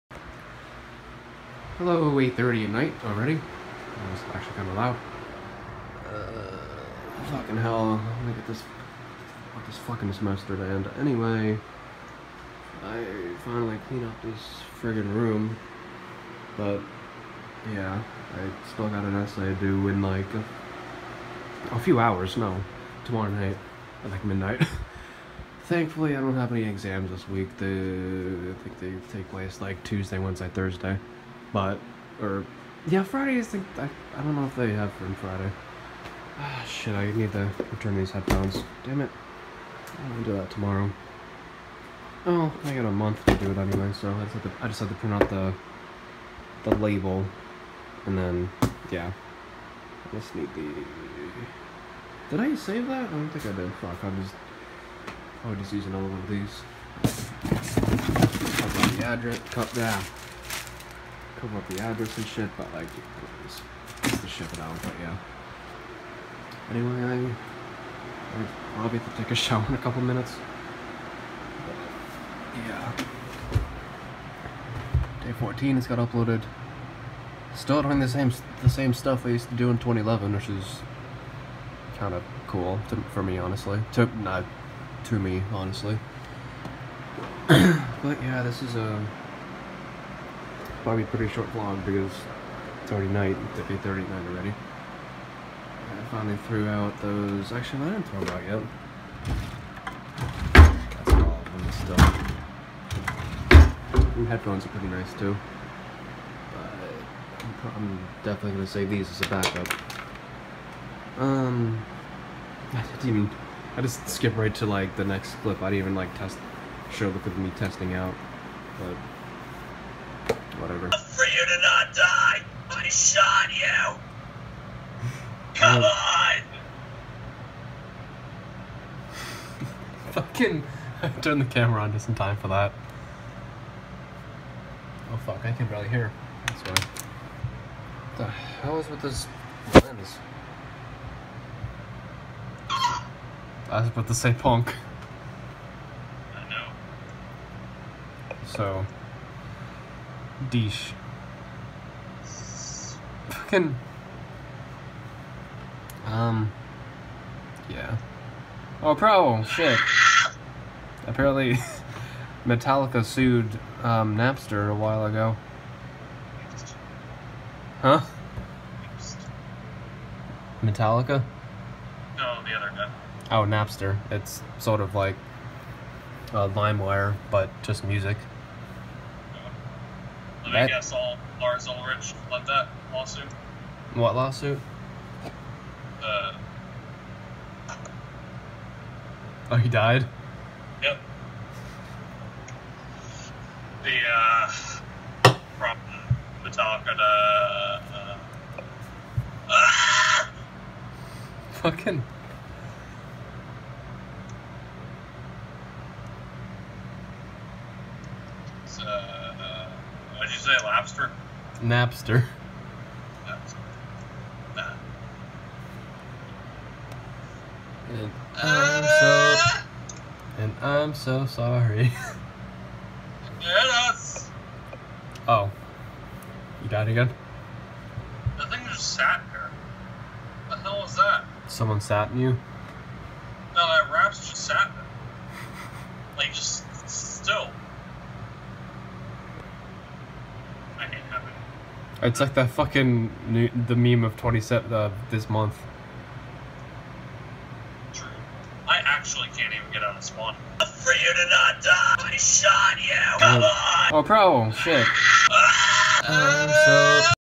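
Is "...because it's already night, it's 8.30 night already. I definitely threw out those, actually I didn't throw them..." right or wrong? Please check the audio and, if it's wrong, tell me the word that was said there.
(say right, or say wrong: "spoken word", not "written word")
wrong: "finally", not "definitely".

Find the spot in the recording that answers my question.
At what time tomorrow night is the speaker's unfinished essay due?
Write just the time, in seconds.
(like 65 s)
24 s.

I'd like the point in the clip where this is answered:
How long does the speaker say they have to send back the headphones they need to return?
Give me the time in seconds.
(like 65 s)
42 s.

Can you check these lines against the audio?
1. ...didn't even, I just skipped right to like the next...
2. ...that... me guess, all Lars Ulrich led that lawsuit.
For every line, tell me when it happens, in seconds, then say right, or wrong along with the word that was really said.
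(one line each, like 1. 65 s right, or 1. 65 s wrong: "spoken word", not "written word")
1. 112 s right
2. 180 s right.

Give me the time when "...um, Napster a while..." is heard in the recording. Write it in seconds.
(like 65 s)
163 s.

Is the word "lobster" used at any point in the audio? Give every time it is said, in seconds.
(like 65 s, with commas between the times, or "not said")
210 s.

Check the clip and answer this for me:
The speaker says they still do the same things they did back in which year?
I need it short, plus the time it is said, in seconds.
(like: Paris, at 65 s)
2011, at 79 s.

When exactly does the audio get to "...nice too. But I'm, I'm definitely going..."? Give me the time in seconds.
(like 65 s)
104 s.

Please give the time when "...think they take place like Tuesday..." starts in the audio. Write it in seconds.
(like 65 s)
28 s.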